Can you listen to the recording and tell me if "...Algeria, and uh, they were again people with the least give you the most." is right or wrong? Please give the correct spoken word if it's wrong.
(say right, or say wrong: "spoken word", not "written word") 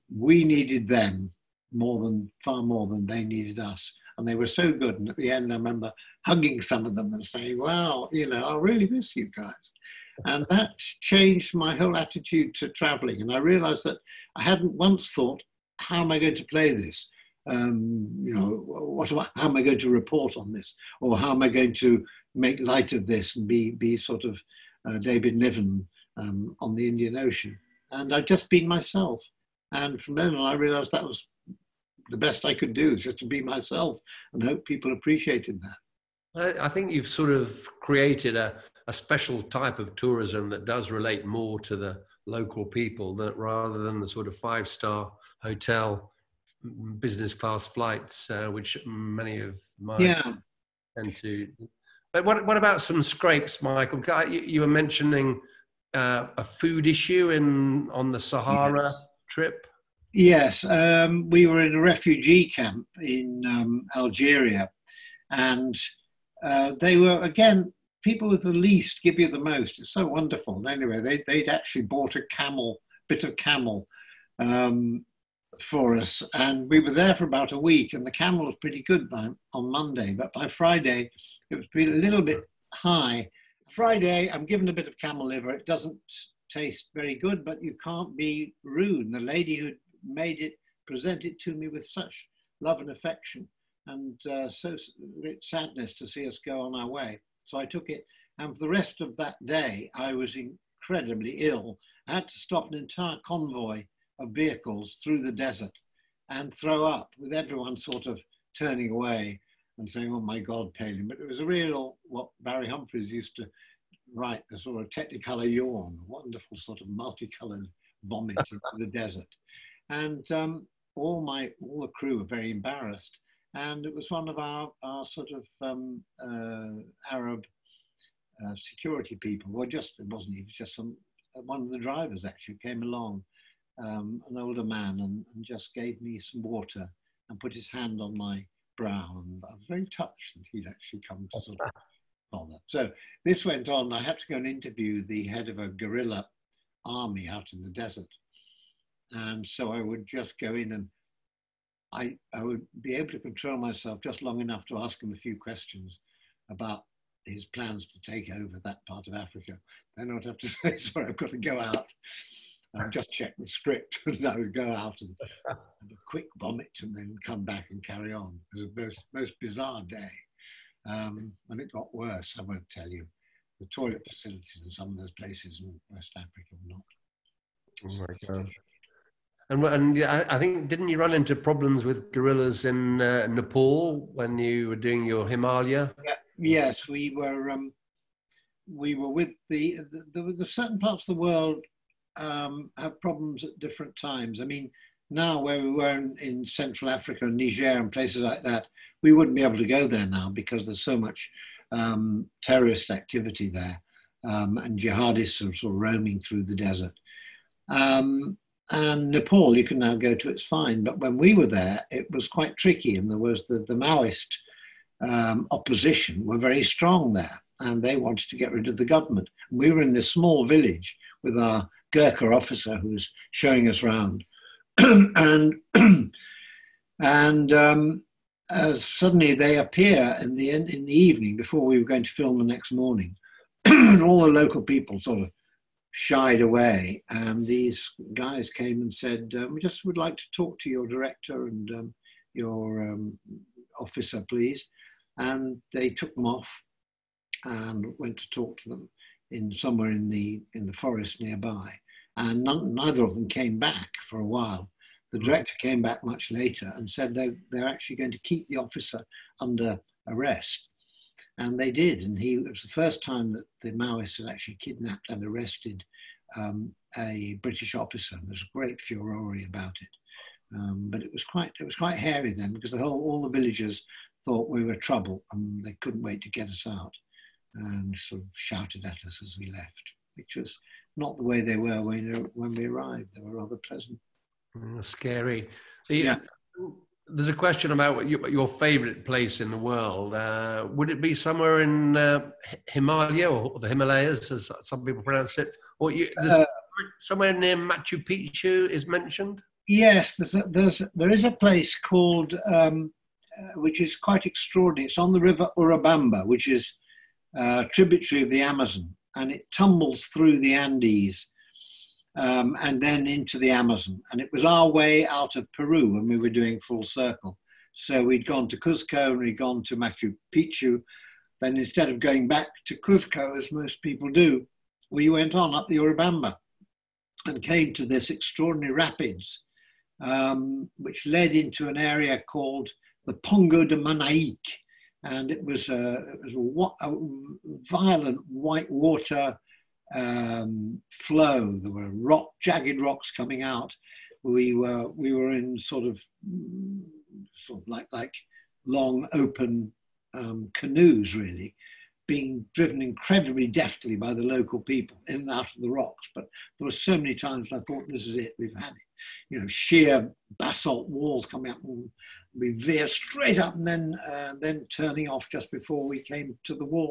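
right.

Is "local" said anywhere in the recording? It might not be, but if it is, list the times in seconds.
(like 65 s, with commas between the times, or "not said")
42 s, 234 s, 354 s.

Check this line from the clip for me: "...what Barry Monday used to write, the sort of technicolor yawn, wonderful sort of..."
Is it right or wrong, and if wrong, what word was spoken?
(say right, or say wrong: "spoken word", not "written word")
wrong: "Humphries", not "Monday".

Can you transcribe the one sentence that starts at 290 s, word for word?
Uh, would it be somewhere in uh, Himalaya or the Himalayas, as some people pronounce it?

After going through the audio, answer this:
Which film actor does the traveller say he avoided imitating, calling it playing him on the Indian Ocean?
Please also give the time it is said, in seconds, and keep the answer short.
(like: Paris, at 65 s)
David Niven, at 24 s.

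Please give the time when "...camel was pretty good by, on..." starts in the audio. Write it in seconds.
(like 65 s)
78 s.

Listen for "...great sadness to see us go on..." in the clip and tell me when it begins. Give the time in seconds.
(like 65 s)
95 s.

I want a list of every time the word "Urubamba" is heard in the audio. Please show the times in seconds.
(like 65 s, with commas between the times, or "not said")
305 s, 325 s.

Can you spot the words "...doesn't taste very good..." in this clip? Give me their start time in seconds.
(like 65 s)
85 s.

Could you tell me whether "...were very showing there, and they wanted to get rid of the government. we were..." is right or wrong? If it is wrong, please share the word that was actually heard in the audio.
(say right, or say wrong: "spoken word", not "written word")
wrong: "strong", not "showing".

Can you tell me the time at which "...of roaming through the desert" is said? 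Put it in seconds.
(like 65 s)
205 s.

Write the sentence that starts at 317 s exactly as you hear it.
So we'd gone to Cuzco and we'd gone to Machu Picchu.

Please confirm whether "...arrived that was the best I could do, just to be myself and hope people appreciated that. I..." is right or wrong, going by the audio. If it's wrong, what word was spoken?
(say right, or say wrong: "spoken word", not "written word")
wrong: "realized", not "arrived".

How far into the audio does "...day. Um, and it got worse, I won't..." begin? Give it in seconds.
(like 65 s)
169 s.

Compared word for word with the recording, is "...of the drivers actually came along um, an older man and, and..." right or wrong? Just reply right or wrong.
right.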